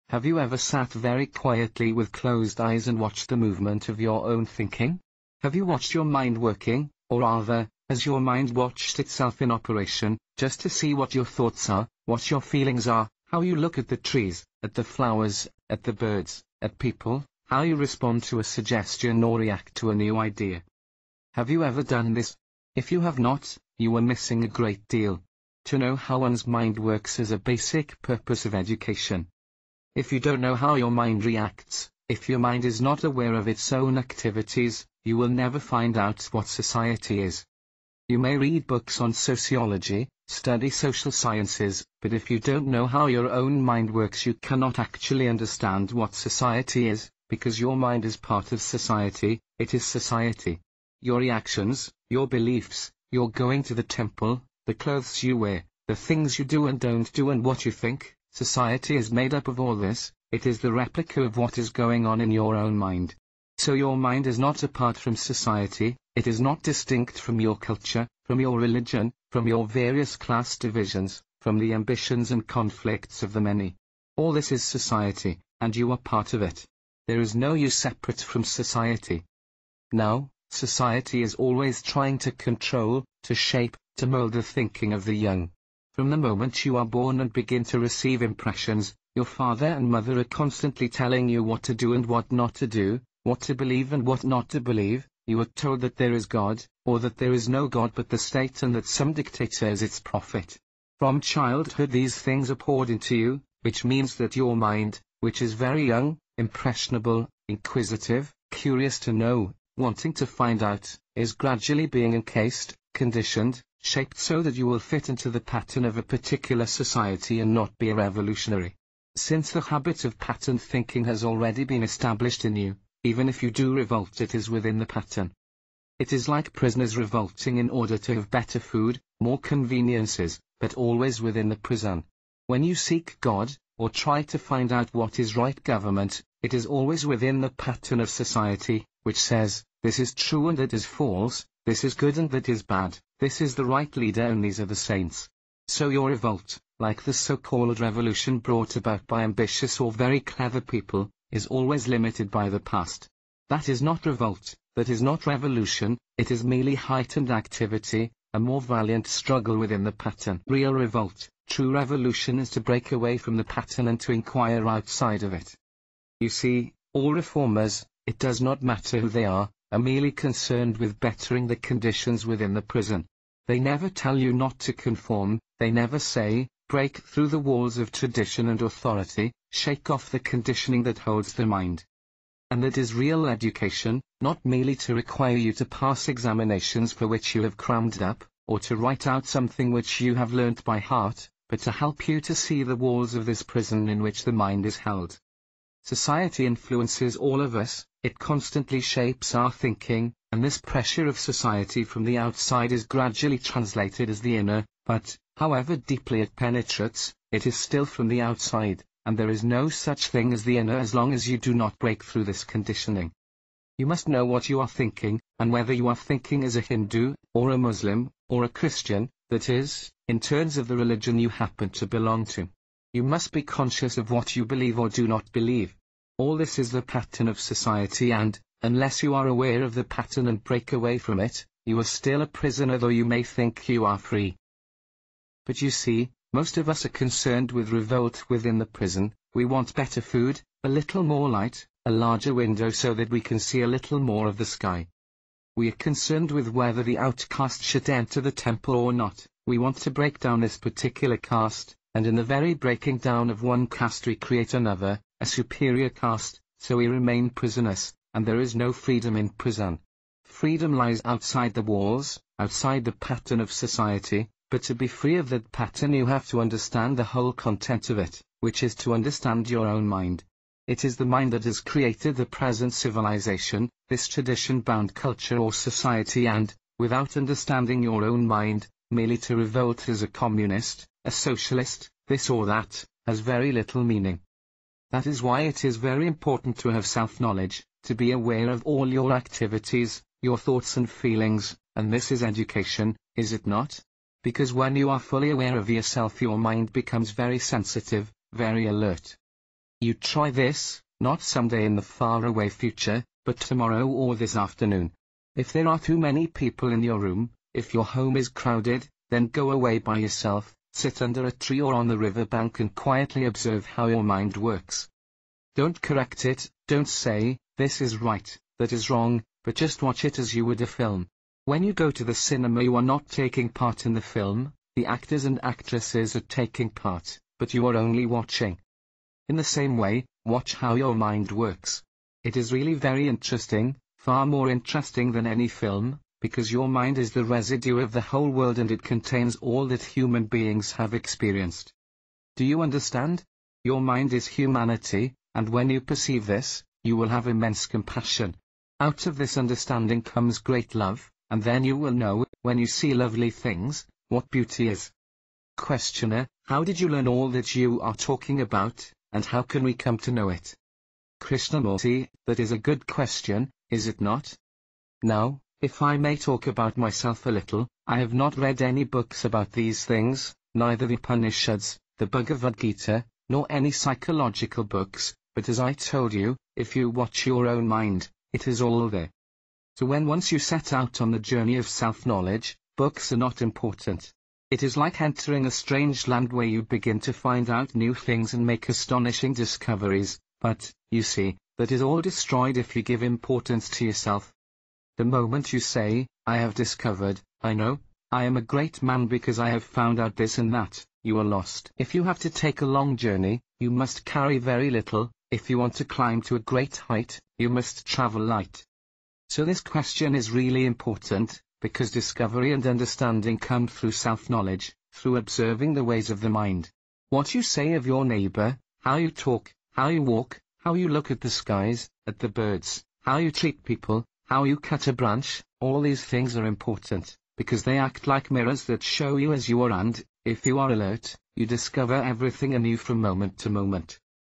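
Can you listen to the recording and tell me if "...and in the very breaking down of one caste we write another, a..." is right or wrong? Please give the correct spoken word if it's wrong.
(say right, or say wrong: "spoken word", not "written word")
wrong: "create", not "write".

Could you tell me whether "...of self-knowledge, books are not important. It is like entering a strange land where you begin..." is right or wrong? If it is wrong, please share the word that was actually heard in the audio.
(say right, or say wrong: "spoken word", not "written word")
right.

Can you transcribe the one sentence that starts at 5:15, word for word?
Don't correct it, don't say, this is right, that is wrong, but just watch it as you would a film.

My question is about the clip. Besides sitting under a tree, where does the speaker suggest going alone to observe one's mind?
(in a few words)
the riverbank.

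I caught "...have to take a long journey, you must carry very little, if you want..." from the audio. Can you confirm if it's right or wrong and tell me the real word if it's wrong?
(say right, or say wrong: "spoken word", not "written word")
right.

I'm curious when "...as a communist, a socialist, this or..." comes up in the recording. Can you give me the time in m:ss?
4:39.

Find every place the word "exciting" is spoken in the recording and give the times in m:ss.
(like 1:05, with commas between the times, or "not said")
not said.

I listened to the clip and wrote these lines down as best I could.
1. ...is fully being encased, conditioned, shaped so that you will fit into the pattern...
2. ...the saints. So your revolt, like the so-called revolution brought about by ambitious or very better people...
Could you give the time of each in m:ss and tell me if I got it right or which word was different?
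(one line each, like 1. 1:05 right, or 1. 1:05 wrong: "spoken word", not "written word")
1. 1:51 wrong: "gradually", not "fully"
2. 2:24 wrong: "clever", not "better".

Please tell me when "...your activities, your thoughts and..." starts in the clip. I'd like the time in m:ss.
4:48.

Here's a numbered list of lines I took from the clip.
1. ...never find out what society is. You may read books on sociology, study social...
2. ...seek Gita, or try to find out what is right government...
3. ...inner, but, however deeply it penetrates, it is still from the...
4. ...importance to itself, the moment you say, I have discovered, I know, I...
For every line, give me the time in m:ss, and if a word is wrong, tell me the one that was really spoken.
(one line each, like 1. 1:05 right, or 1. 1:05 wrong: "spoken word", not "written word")
1. 0:35 right
2. 2:12 wrong: "God", not "Gita"
3. 3:24 right
4. 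6:33 wrong: "yourself", not "itself".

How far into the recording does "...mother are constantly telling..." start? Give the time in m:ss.
1:29.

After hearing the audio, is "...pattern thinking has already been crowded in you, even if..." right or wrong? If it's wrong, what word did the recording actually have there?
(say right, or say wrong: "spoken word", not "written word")
wrong: "established", not "crowded".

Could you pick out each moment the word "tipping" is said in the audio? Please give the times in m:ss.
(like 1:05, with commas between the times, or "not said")
not said.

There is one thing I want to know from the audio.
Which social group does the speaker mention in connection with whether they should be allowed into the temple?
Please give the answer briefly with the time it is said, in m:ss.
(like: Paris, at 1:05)
the outcast, at 4:06.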